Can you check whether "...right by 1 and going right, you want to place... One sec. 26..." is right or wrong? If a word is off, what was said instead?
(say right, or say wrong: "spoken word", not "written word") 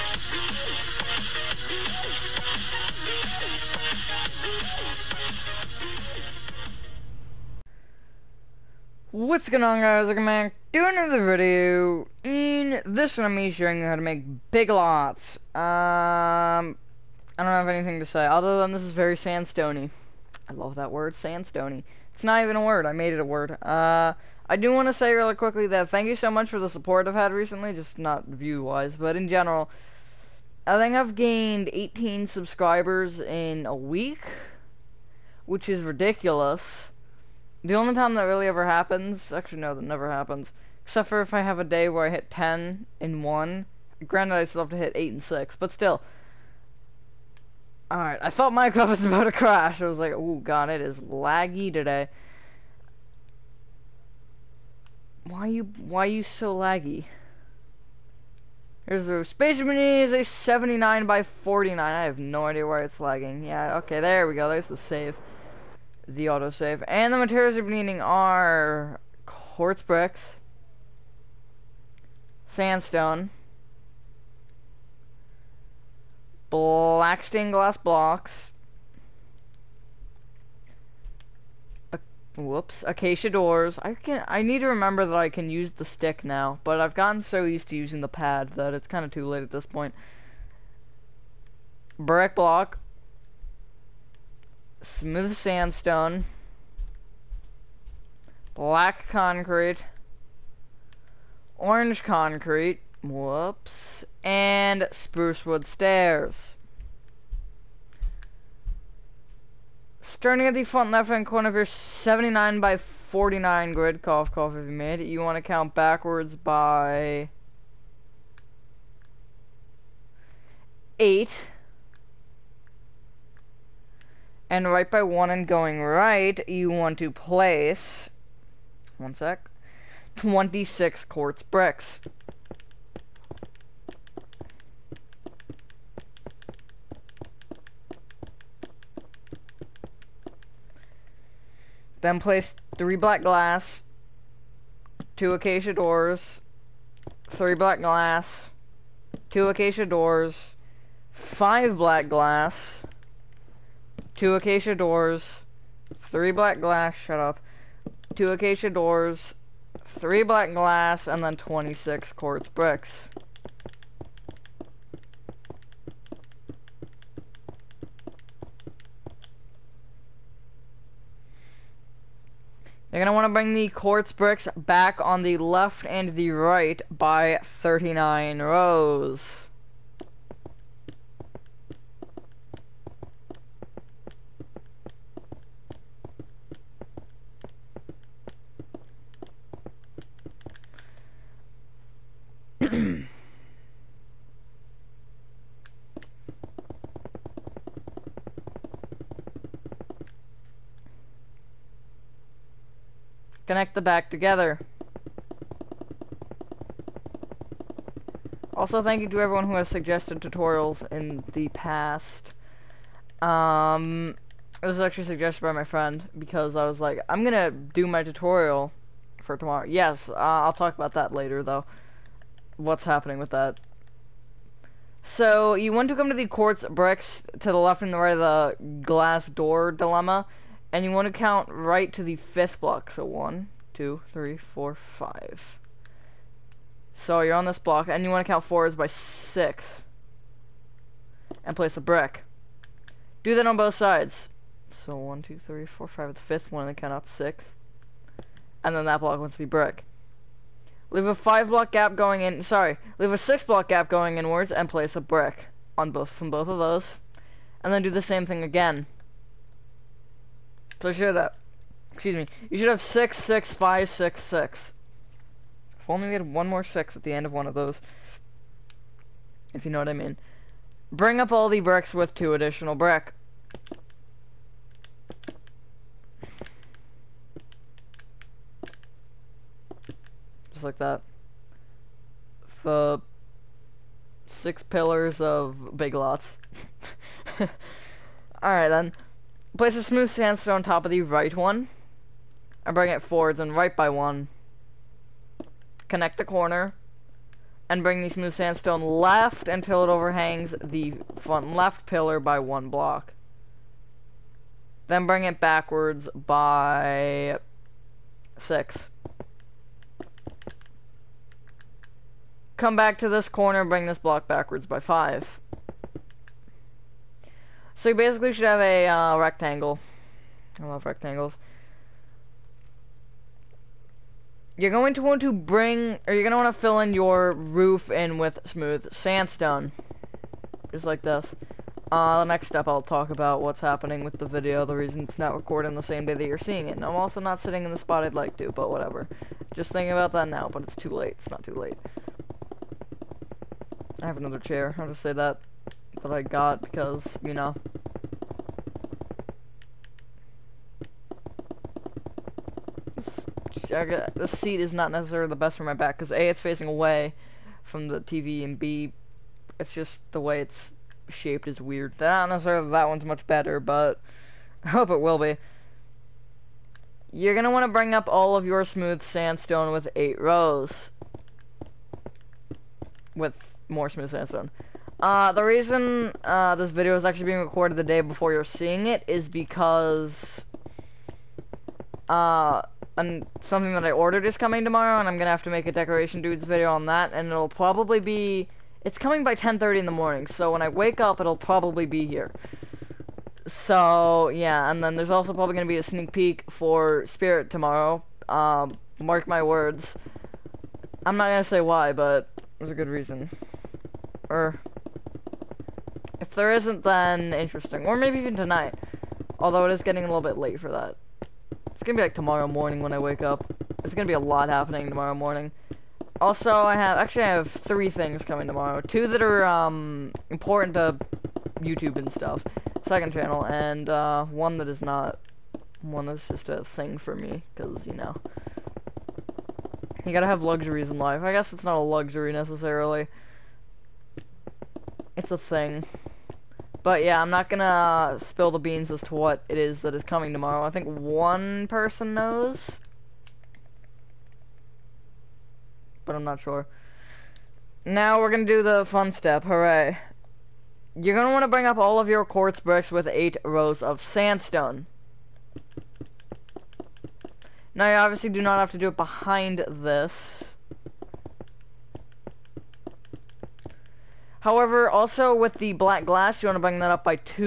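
right.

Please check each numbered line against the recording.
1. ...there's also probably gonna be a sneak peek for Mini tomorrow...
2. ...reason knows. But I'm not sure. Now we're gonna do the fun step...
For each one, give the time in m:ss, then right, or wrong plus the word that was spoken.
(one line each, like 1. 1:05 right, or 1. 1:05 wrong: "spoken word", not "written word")
1. 6:34 wrong: "Spirit", not "Mini"
2. 7:21 wrong: "person", not "reason".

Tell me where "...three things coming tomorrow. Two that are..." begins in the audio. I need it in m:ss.
6:57.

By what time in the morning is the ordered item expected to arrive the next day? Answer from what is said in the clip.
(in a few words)
10:30.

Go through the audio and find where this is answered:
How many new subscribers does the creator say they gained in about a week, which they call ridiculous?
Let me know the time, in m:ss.
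0:31.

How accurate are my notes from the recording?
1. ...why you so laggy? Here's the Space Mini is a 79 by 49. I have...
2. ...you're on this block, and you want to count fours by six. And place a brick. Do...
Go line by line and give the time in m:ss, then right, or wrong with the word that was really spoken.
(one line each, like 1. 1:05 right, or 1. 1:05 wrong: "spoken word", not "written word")
1. 0:55 right
2. 3:57 right.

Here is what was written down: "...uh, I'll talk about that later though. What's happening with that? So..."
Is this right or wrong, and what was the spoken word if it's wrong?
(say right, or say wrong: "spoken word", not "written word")
right.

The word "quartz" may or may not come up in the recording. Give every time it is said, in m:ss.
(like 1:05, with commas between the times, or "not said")
1:09, 2:11, 2:42, 2:53, 3:46, 7:32.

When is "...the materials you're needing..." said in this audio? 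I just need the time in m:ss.
1:07.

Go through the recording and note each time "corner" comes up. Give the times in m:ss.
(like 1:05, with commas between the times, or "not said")
1:51, 4:56, 5:13.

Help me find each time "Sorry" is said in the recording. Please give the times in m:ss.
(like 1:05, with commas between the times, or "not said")
4:12.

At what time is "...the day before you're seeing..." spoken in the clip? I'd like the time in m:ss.
6:17.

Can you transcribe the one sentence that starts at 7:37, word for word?
Now you obviously do not have to do it behind this.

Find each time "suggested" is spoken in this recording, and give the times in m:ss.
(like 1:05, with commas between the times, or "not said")
3:29, 3:35.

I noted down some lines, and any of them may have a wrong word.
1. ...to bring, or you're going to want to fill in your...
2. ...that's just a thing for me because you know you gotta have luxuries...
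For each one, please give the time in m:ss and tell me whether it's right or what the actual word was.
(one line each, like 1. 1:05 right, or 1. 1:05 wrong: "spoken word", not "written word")
1. 5:25 right
2. 7:06 right.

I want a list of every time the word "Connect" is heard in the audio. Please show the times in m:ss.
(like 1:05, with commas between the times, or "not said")
3:23, 4:55.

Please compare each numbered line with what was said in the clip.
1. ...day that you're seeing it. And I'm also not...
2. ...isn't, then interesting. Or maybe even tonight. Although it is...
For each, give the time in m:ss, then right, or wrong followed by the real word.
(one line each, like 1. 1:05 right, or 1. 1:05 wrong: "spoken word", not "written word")
1. 5:36 right
2. 6:46 right.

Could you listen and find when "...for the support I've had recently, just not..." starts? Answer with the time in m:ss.
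0:26.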